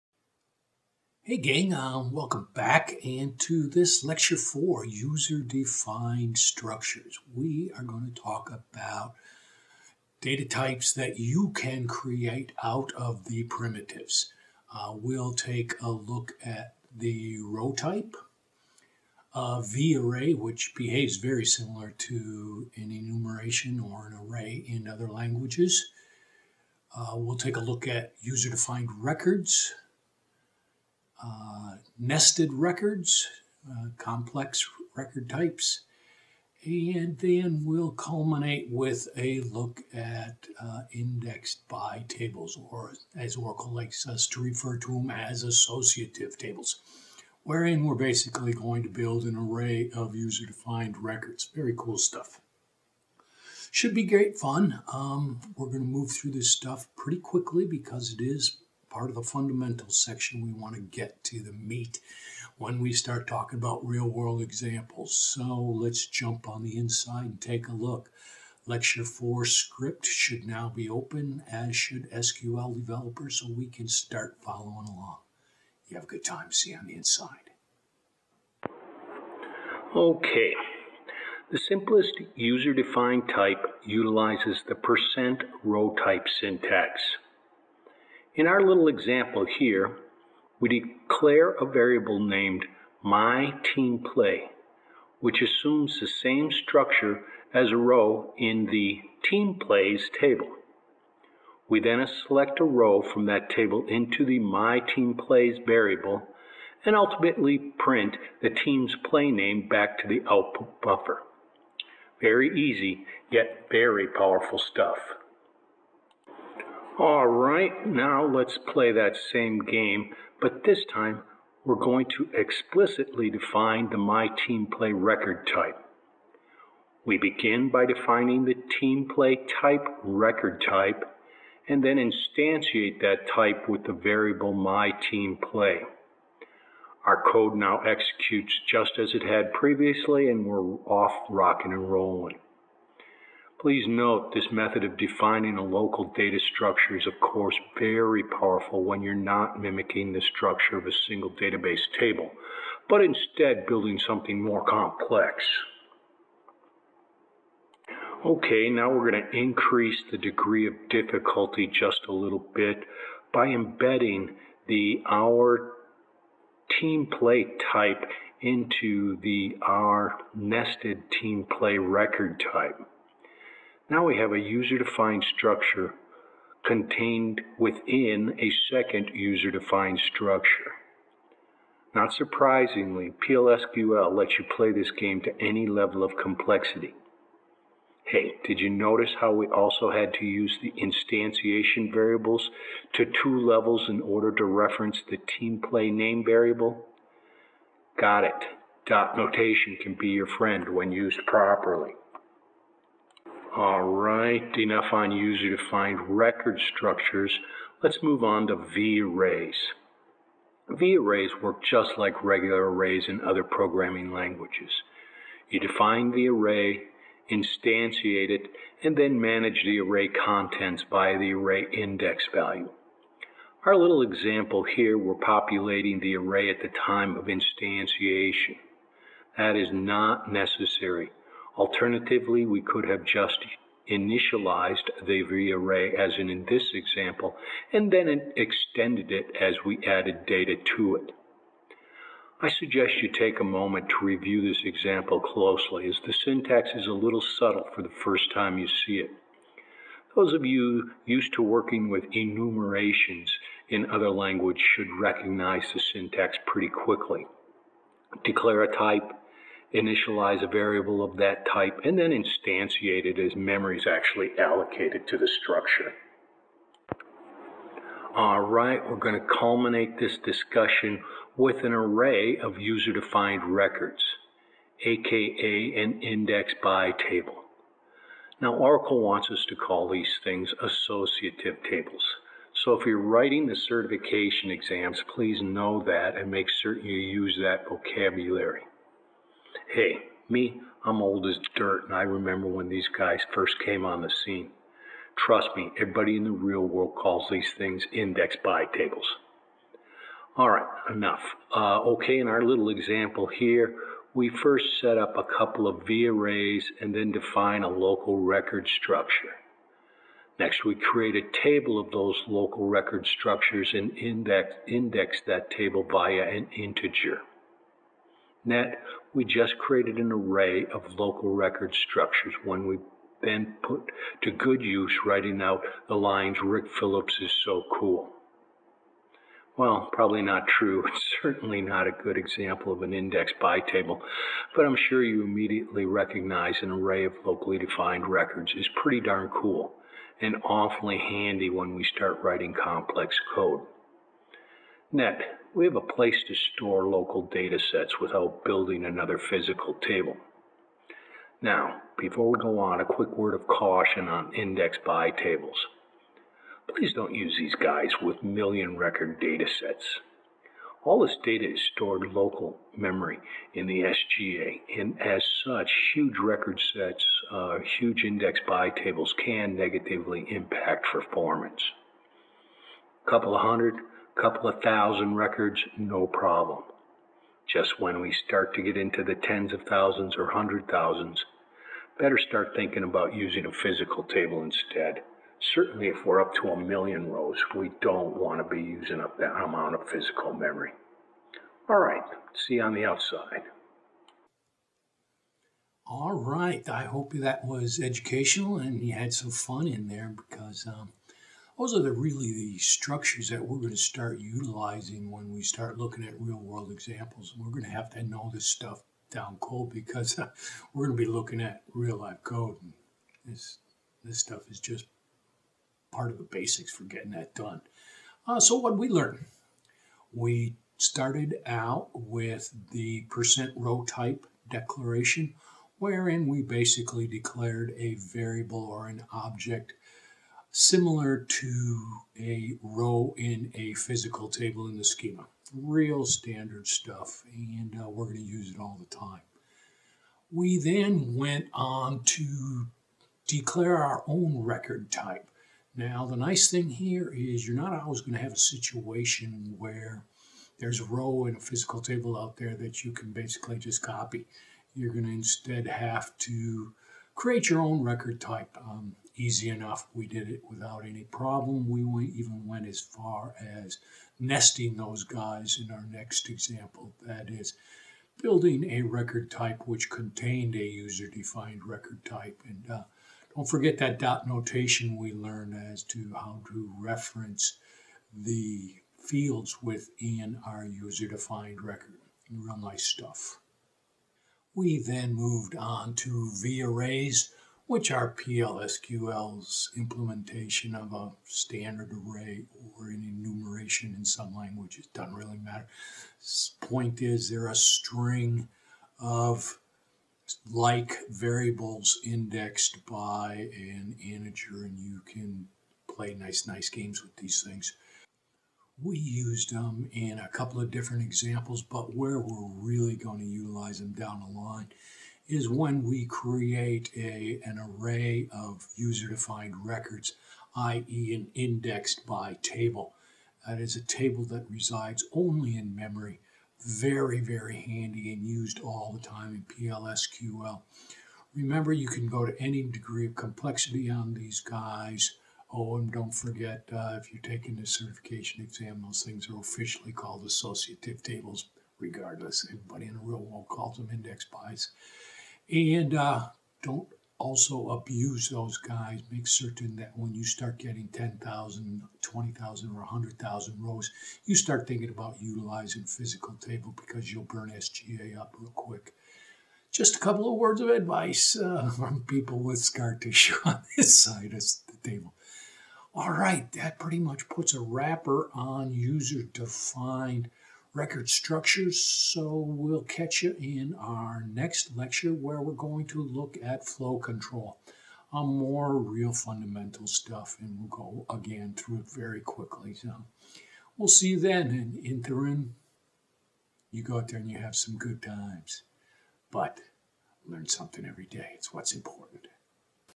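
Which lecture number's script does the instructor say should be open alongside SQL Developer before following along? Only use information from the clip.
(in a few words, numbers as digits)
Lecture 4.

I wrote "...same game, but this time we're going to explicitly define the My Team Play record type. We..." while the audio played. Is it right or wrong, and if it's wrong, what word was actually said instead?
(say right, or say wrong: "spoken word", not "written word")
right.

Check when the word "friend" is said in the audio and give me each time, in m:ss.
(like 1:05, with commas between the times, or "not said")
3:20.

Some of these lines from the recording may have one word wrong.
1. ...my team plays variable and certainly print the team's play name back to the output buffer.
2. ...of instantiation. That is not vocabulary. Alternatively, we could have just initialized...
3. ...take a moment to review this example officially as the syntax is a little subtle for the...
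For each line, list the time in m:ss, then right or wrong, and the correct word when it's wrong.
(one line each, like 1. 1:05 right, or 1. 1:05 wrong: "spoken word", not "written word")
1. 1:44 wrong: "ultimately", not "certainly"
2. 3:47 wrong: "necessary", not "vocabulary"
3. 4:03 wrong: "closely", not "officially".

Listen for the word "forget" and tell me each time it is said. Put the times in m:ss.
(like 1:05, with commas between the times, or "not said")
7:53, 8:56.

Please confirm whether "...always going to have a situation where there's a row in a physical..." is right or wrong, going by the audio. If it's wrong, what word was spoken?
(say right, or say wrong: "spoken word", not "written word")
right.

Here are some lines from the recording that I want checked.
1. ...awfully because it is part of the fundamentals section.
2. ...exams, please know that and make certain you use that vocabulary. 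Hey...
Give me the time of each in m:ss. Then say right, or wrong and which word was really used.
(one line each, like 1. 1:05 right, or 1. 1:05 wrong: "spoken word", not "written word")
1. 0:57 wrong: "quickly", not "awfully"
2. 4:44 right.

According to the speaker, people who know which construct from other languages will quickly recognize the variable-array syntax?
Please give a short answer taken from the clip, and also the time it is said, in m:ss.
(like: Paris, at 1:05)
enumerations, at 4:12.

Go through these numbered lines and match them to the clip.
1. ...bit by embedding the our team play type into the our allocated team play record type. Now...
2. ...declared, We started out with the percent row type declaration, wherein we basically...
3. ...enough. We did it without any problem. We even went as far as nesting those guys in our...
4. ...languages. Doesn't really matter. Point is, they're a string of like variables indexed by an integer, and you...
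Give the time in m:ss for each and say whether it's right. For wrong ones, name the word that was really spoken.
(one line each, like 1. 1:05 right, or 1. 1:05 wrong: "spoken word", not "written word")
1. 2:42 wrong: "nested", not "allocated"
2. 6:58 wrong: "learned", not "declared"
3. 7:39 right
4. 8:14 right.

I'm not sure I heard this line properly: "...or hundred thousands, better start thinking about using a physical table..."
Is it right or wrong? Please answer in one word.
right.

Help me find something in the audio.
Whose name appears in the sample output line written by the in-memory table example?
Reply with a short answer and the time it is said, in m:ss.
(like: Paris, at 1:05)
Rick Phillips, at 5:26.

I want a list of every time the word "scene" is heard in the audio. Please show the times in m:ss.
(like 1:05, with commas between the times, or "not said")
4:54.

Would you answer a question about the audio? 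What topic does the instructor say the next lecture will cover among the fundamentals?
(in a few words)
flow control.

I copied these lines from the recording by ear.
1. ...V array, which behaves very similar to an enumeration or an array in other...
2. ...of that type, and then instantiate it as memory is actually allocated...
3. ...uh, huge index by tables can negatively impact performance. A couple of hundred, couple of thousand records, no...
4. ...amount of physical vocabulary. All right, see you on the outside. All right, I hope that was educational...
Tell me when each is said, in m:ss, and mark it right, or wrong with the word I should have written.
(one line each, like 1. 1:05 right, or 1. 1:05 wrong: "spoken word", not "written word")
1. 0:19 right
2. 4:21 right
3. 6:07 right
4. 6:29 wrong: "memory", not "vocabulary".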